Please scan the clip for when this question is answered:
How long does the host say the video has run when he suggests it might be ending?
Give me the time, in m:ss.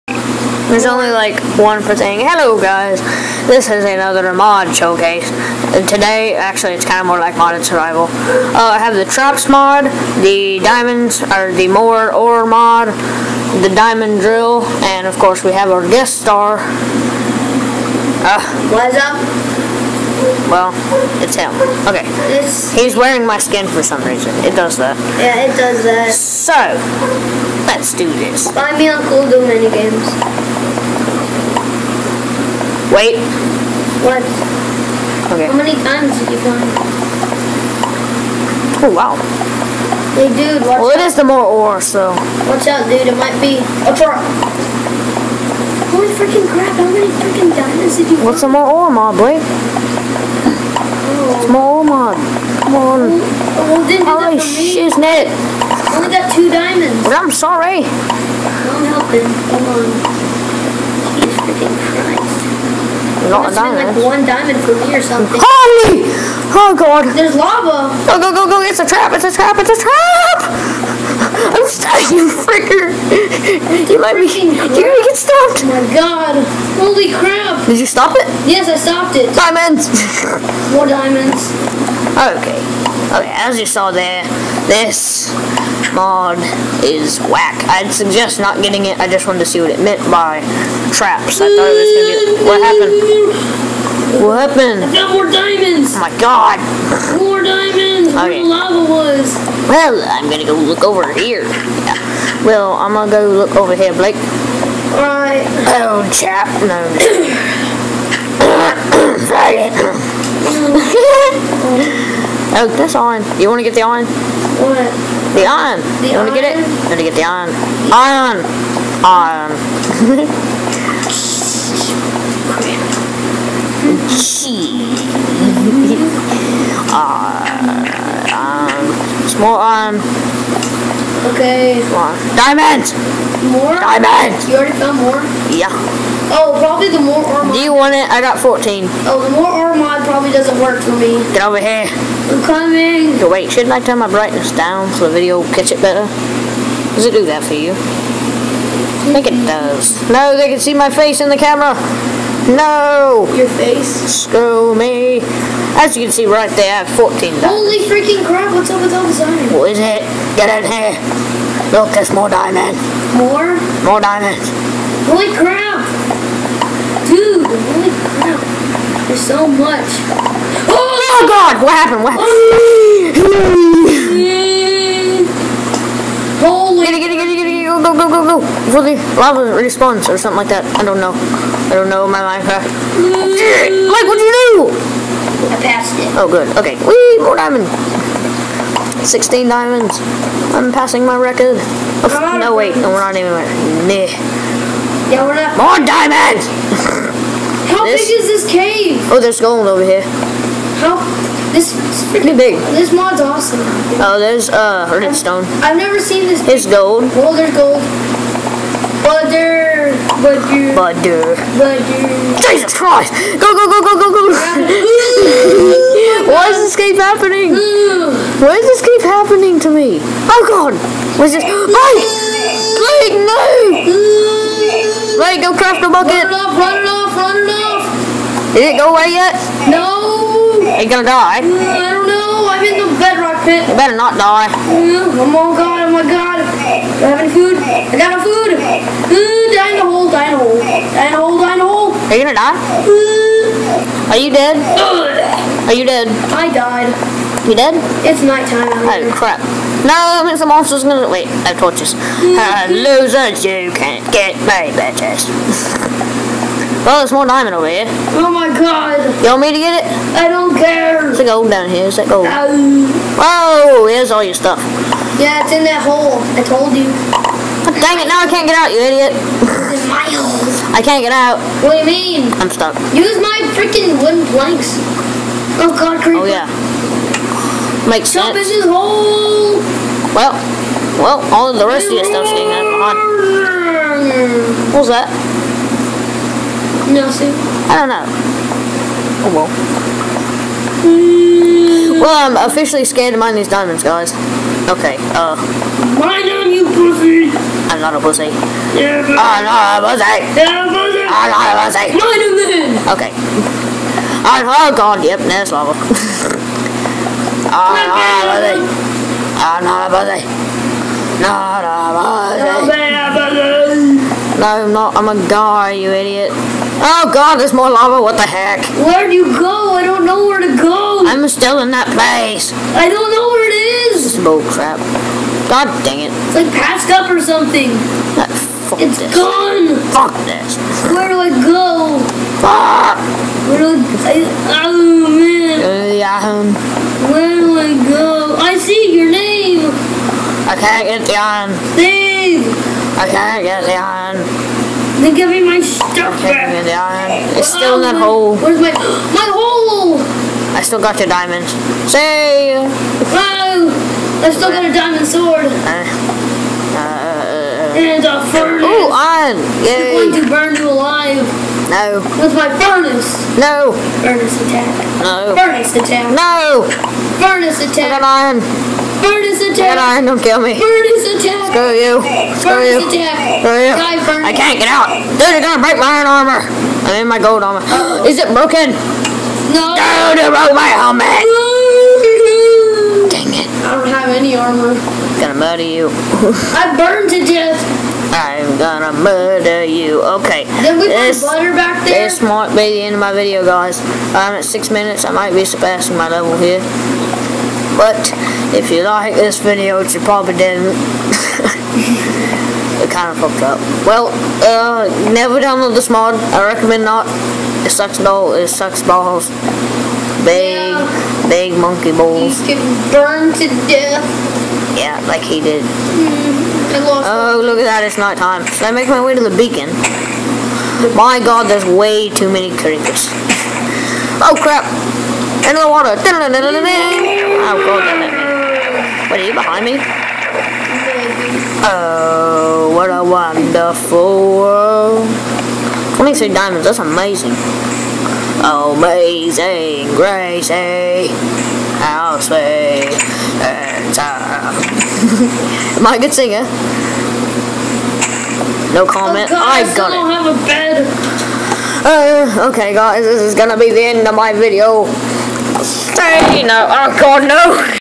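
6:34.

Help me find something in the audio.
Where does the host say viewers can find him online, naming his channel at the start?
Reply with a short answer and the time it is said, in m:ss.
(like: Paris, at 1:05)
Cool Do Games, at 0:29.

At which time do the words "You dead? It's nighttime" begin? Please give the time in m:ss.
4:07.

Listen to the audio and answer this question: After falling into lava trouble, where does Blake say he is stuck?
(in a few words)
bedrock pit.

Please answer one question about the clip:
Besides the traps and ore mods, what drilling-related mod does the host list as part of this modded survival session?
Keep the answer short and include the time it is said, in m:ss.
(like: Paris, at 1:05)
diamond drill, at 0:13.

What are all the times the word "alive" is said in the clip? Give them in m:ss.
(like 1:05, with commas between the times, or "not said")
6:00.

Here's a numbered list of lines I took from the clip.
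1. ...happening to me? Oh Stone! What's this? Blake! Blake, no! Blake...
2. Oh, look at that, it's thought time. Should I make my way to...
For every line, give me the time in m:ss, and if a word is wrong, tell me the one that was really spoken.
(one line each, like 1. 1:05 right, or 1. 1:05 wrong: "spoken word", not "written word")
1. 3:39 wrong: "God", not "Stone"
2. 6:56 wrong: "night", not "thought".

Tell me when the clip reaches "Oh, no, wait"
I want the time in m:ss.
3:12.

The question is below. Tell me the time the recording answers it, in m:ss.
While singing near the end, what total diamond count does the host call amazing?
7:15.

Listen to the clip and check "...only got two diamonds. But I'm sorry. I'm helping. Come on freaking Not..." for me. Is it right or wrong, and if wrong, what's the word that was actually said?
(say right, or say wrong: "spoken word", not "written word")
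right.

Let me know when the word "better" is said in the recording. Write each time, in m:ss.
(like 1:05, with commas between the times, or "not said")
2:25, 3:53.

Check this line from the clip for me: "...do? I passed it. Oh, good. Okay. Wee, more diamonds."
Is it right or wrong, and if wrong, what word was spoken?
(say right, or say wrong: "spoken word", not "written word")
right.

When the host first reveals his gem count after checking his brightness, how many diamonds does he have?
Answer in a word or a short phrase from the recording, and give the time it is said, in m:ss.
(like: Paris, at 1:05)
14, at 2:36.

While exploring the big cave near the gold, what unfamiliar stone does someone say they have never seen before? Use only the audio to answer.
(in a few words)
Hornet Stone.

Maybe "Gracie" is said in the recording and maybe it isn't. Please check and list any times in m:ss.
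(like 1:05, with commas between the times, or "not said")
7:19.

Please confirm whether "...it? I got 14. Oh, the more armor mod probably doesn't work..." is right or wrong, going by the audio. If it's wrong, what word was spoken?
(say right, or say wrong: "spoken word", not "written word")
right.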